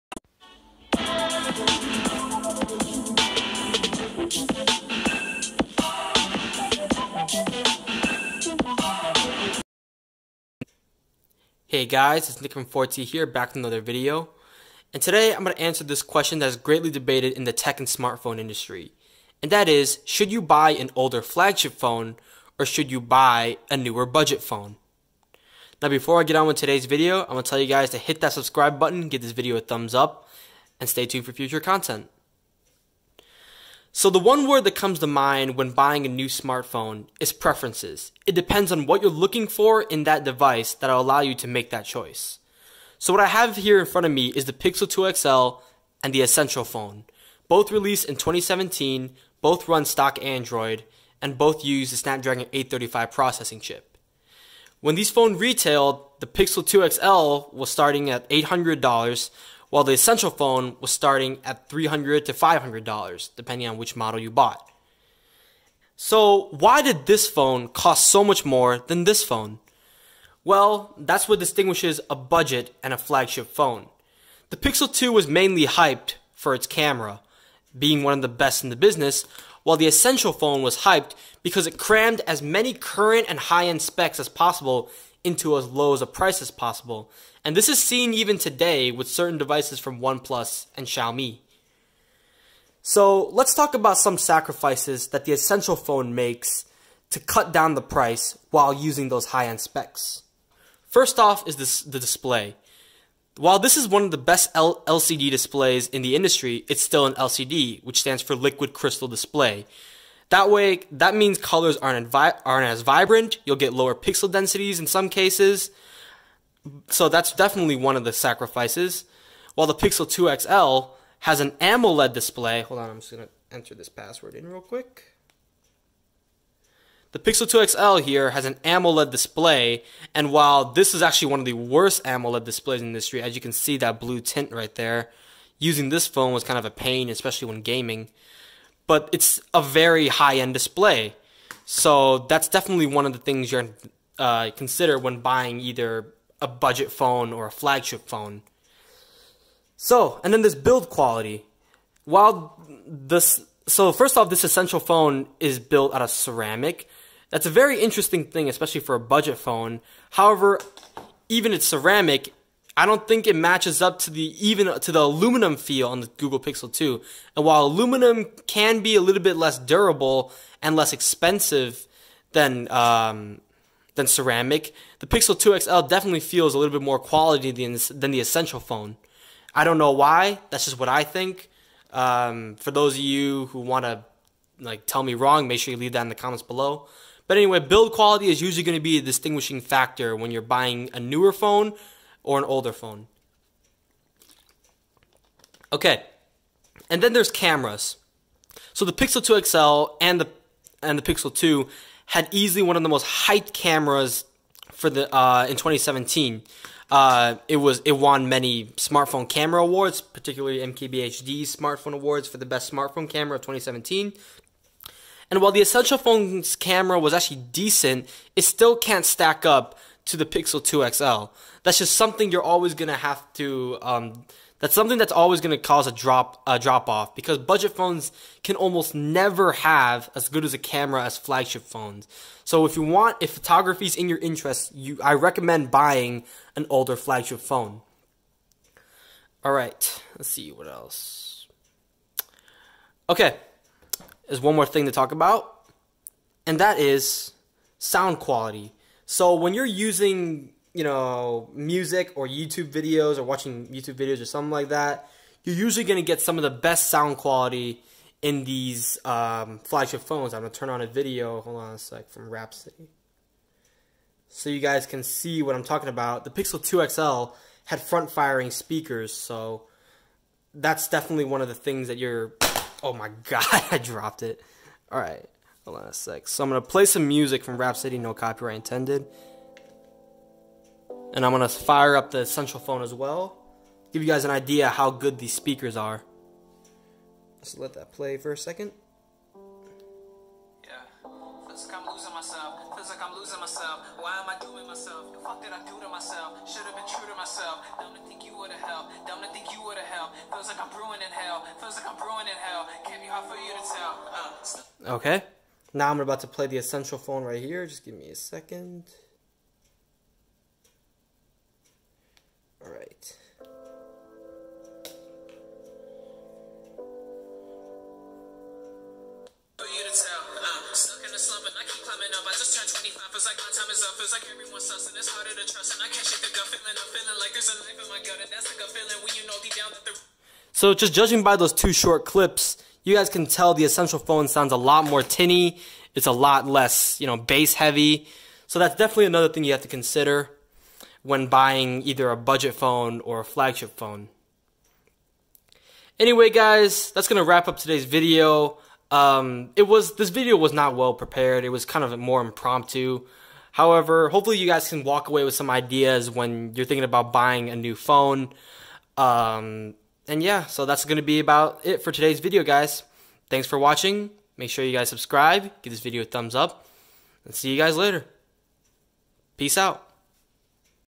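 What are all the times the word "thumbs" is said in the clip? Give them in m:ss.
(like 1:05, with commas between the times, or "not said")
0:29, 6:06.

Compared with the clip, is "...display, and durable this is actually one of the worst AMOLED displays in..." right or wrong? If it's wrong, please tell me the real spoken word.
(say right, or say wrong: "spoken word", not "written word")
wrong: "while", not "durable".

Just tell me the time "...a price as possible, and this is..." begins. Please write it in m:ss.
1:26.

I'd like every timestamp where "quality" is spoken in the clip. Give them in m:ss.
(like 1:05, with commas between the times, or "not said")
2:30, 2:56, 3:07, 4:08, 4:17.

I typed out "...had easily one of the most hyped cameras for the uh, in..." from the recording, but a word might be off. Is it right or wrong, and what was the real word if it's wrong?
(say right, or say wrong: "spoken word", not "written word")
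right.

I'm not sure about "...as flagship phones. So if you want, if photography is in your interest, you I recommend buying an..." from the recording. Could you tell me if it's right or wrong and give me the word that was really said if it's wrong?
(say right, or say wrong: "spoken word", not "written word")
right.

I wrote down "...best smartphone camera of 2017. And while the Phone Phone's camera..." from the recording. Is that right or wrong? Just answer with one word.
wrong.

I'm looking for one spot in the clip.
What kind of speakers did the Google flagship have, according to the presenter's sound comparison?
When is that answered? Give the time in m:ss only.
4:27.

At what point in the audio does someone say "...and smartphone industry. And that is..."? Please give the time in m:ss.
0:17.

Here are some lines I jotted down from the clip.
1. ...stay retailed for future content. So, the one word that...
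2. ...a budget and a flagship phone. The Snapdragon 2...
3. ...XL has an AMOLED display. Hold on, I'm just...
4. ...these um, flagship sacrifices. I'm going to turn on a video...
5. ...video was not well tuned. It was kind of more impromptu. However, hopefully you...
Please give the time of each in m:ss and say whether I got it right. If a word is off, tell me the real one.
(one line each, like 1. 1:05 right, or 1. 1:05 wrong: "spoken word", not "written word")
1. 0:30 wrong: "tuned", not "retailed"
2. 1:12 wrong: "Pixel", not "Snapdragon"
3. 2:00 right
4. 4:18 wrong: "phones", not "sacrifices"
5. 5:50 wrong: "prepared", not "tuned".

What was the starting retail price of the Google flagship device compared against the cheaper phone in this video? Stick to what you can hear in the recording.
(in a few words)
$800.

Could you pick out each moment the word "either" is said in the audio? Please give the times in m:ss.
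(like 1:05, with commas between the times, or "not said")
2:25, 5:41.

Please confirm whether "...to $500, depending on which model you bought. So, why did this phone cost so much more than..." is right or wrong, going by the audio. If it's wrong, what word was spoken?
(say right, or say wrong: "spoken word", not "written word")
right.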